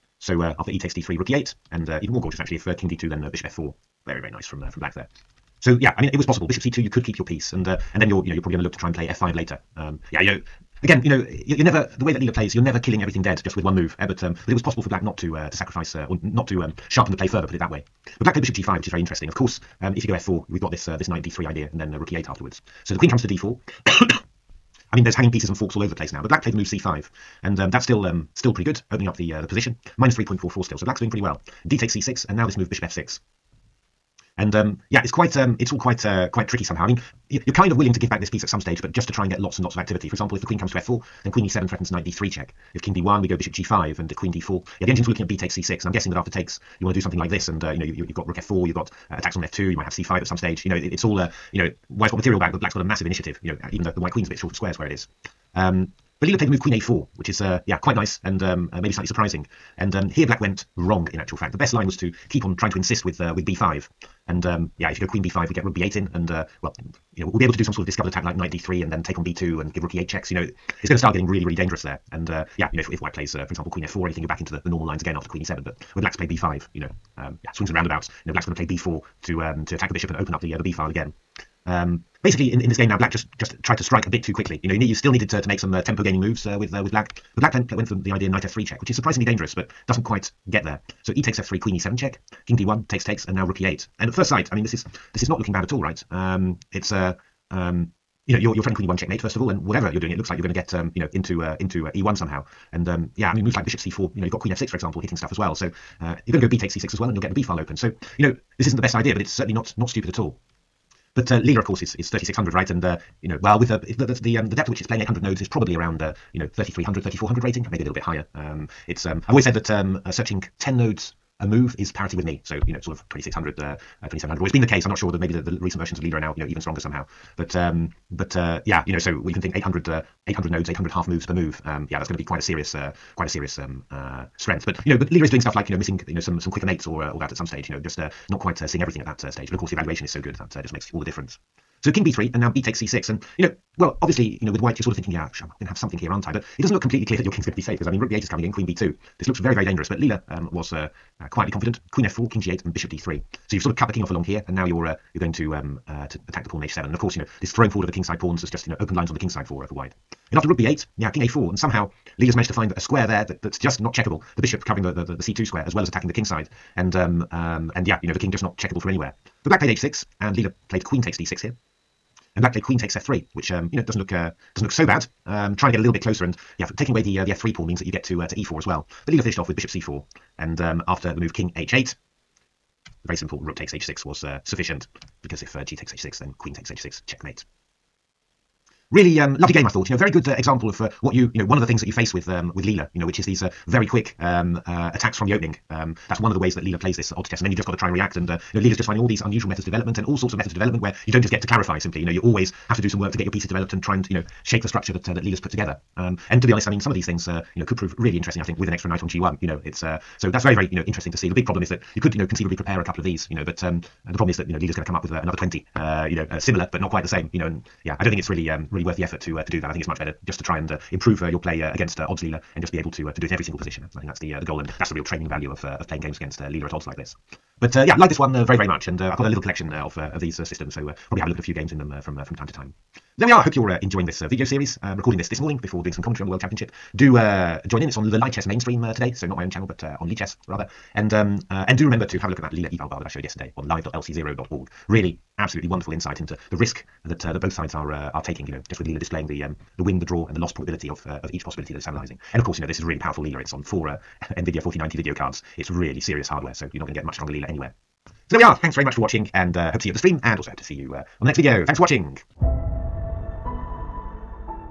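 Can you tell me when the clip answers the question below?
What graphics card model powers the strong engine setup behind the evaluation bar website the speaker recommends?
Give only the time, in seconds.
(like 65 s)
254 s.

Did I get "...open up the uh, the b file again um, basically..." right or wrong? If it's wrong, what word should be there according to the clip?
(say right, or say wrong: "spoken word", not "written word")
right.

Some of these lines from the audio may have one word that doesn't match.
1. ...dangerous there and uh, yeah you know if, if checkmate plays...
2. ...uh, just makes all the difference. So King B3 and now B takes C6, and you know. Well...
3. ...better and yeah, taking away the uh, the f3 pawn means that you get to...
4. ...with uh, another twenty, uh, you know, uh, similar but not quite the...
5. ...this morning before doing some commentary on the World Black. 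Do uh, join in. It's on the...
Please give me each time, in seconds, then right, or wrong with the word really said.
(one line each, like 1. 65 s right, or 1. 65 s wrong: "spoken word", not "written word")
1. 71 s wrong: "white", not "checkmate"
2. 140 s right
3. 176 s wrong: "closer", not "better"
4. 215 s right
5. 235 s wrong: "Championship", not "Black".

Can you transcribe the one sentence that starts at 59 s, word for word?
And um, here Black went wrong in actual fact.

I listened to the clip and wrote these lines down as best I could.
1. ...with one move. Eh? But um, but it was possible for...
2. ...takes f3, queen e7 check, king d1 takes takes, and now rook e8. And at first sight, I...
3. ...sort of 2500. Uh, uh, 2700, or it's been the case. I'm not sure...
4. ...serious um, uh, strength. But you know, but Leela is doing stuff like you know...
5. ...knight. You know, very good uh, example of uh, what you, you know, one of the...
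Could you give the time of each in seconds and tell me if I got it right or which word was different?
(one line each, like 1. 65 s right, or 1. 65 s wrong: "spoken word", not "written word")
1. 13 s right
2. 91 s right
3. 122 s wrong: "2600", not "2500"
4. 133 s right
5. 189 s wrong: "thought", not "knight".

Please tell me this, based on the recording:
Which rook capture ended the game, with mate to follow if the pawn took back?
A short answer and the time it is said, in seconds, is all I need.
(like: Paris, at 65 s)
Rook takes h6, at 183 s.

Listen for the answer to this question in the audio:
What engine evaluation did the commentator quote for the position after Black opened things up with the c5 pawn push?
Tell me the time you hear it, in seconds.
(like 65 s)
29 s.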